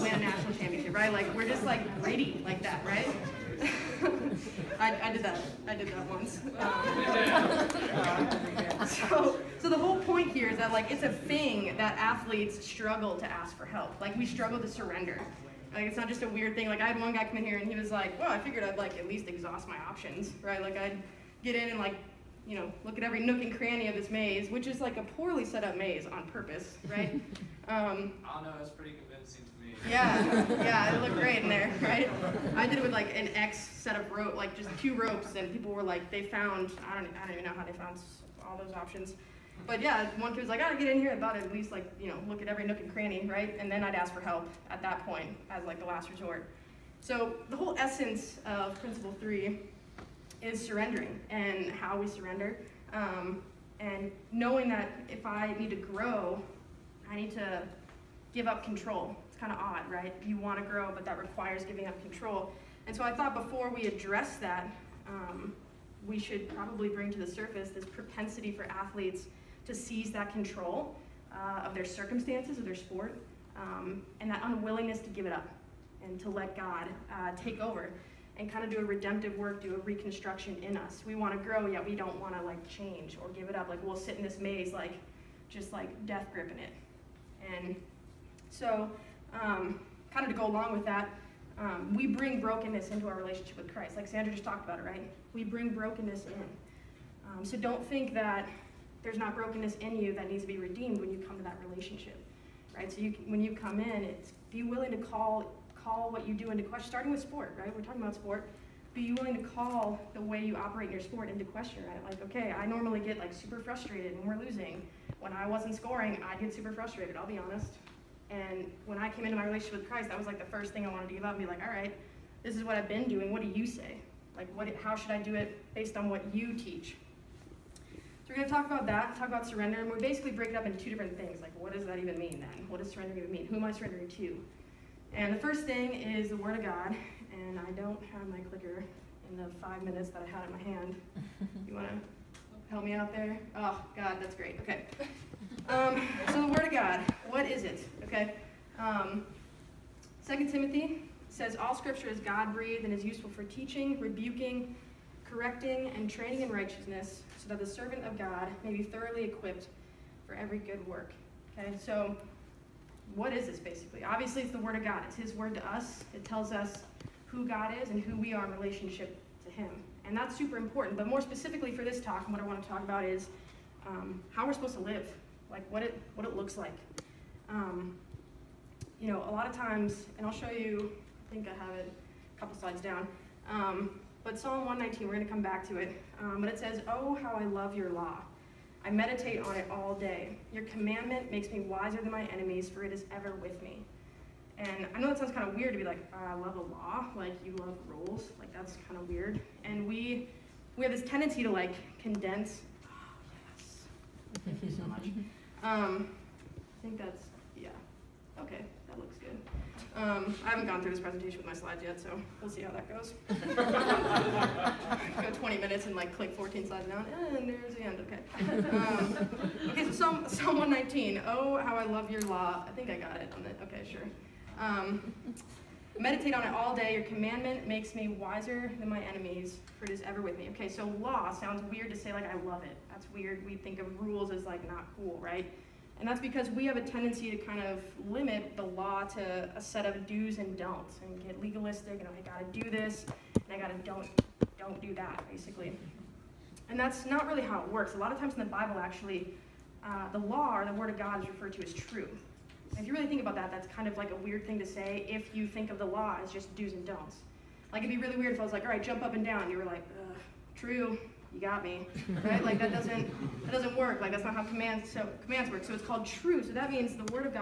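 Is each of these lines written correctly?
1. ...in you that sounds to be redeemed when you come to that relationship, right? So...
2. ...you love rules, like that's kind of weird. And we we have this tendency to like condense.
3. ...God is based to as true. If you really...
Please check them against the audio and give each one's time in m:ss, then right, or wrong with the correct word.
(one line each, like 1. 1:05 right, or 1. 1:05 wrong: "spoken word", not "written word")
1. 1:39 wrong: "needs", not "sounds"
2. 3:17 right
3. 4:10 wrong: "referred", not "based".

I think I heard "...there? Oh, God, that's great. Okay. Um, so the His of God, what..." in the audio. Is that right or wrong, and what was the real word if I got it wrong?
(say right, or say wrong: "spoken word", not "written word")
wrong: "Word", not "His".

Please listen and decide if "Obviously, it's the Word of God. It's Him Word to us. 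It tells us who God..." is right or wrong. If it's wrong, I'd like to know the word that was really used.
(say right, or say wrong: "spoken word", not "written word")
wrong: "His", not "Him".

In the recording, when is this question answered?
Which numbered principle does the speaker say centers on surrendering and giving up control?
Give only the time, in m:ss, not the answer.
0:48.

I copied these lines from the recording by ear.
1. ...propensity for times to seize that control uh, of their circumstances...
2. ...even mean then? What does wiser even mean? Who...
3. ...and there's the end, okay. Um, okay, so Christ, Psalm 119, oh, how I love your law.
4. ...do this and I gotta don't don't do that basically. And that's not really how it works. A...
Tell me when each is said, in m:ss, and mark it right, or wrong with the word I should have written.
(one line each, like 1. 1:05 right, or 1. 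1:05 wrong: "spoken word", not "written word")
1. 1:07 wrong: "athletes", not "times"
2. 2:11 wrong: "surrender", not "wiser"
3. 3:37 wrong: "Psalm", not "Christ"
4. 4:02 right.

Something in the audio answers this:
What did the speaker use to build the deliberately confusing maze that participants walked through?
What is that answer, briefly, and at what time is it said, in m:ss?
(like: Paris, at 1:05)
Two ropes, at 0:34.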